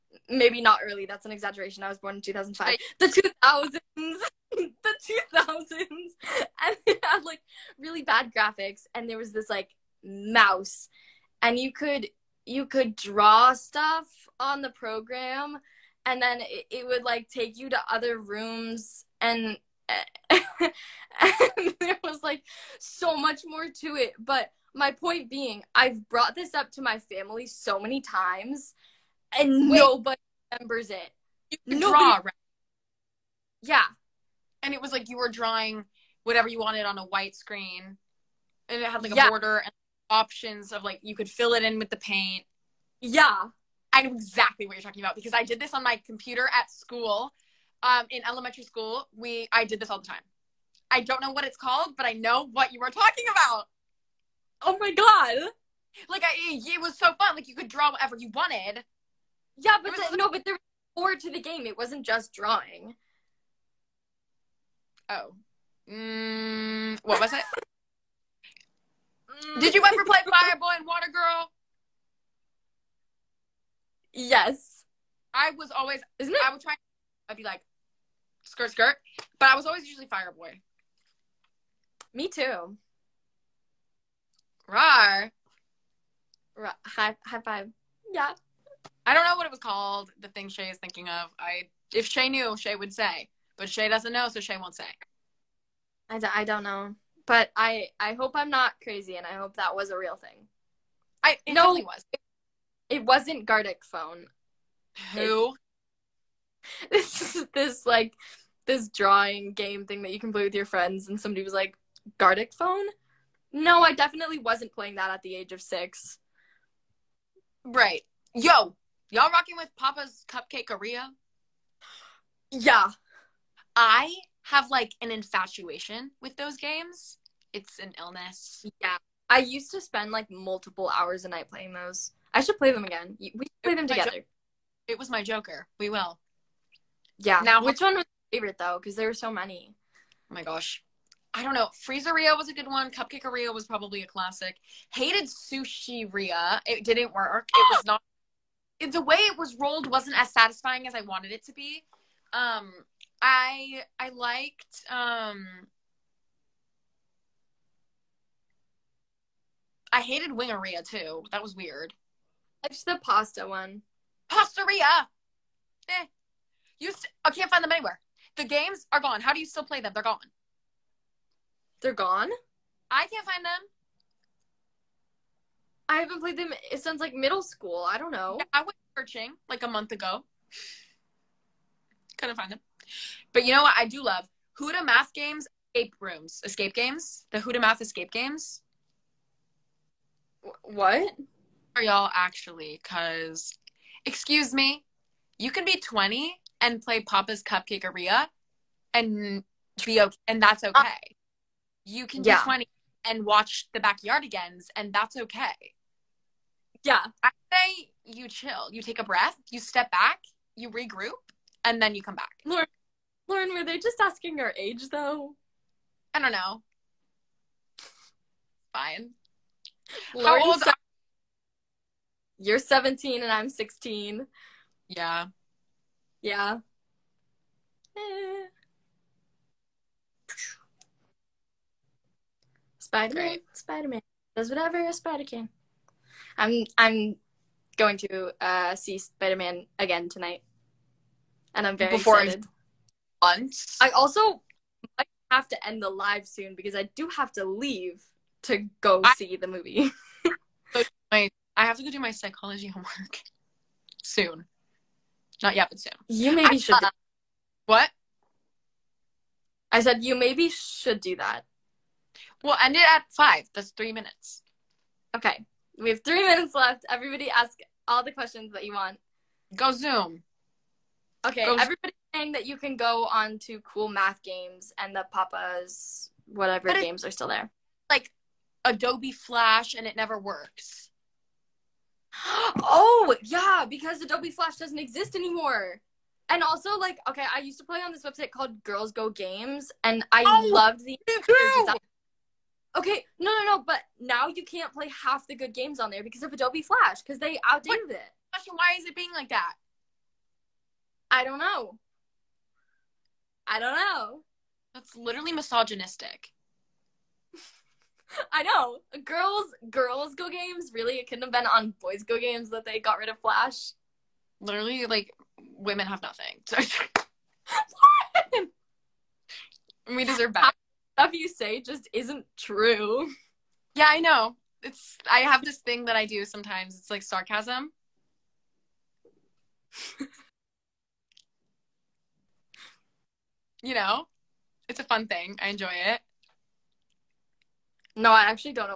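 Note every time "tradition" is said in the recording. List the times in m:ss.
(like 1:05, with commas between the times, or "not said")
not said.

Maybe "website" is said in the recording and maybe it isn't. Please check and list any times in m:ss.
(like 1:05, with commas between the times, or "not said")
4:48.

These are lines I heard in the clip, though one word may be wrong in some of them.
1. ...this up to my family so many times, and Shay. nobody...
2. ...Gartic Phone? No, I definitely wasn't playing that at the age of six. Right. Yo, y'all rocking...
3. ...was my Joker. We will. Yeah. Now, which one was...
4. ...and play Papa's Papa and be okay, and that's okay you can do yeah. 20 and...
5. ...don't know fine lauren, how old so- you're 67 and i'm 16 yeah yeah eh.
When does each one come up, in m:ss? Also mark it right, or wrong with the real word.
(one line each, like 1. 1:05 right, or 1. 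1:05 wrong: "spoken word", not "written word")
1. 0:26 wrong: "Wait", not "Shay"
2. 1:52 right
3. 2:14 right
4. 3:16 wrong: "Cupcakeria", not "Papa"
5. 3:36 wrong: "17", not "67".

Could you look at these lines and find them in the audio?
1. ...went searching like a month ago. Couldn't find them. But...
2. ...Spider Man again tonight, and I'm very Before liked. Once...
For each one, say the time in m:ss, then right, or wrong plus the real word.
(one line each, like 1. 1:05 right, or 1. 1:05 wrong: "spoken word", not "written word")
1. 2:58 right
2. 3:58 wrong: "excited", not "liked".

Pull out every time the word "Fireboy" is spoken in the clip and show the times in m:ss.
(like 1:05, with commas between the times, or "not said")
1:10, 1:20.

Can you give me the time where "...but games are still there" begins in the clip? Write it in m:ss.
4:36.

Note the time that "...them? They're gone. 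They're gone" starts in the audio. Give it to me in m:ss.
2:49.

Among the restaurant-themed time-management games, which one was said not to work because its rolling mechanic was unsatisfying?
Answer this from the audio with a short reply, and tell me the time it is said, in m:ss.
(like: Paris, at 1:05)
Sushiria, at 2:25.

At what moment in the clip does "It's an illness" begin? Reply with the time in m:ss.
2:07.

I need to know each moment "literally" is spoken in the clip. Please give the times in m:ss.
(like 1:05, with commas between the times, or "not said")
5:04, 5:14.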